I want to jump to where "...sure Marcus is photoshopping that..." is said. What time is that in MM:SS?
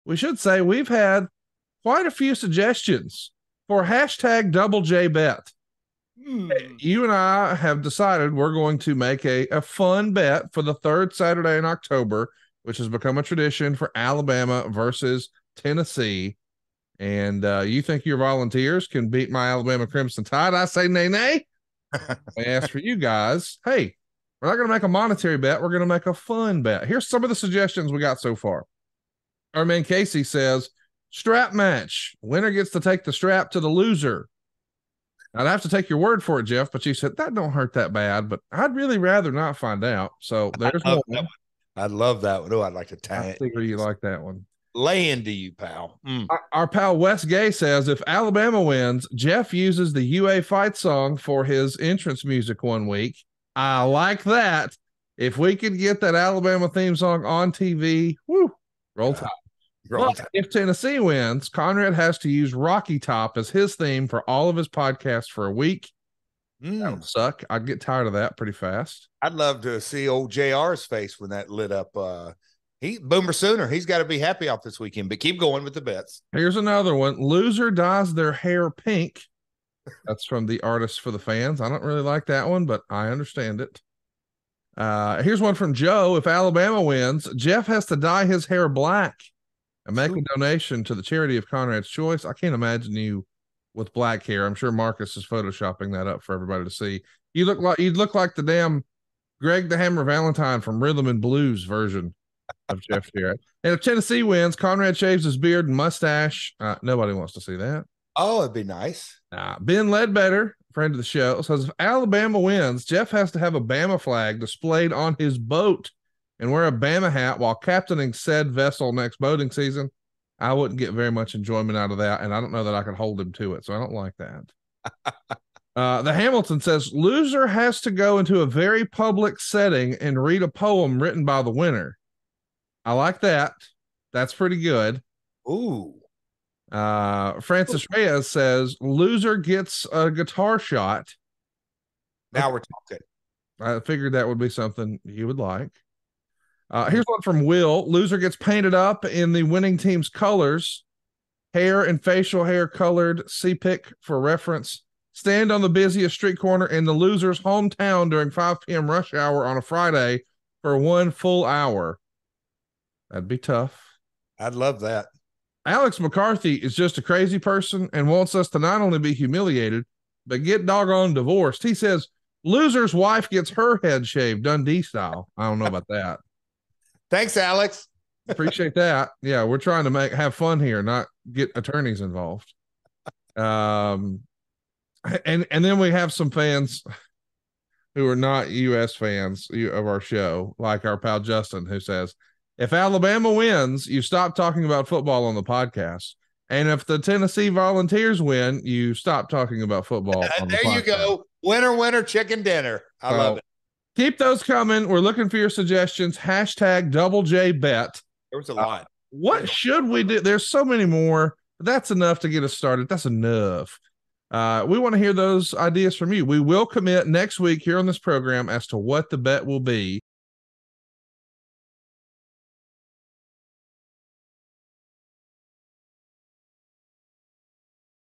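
01:34.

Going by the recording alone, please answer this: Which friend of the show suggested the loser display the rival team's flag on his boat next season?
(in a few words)
Ben Ledbetter.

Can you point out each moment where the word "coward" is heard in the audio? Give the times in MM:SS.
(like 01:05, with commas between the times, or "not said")
not said.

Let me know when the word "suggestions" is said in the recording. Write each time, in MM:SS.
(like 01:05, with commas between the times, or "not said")
00:02, 00:27, 03:25.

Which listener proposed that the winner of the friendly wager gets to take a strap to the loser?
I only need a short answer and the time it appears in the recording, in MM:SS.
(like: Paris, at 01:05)
Casey, at 00:29.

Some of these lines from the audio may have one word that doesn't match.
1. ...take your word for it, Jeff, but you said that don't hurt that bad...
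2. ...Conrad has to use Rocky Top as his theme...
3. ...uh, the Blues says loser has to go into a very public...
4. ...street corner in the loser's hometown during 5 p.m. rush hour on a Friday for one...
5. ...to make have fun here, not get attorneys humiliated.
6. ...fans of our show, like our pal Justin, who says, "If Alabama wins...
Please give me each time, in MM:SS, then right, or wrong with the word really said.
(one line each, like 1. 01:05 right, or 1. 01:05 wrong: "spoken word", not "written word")
1. 00:35 right
2. 01:01 right
3. 02:05 wrong: "Hamilton", not "Blues"
4. 02:36 right
5. 02:59 wrong: "involved", not "humiliated"
6. 03:08 right.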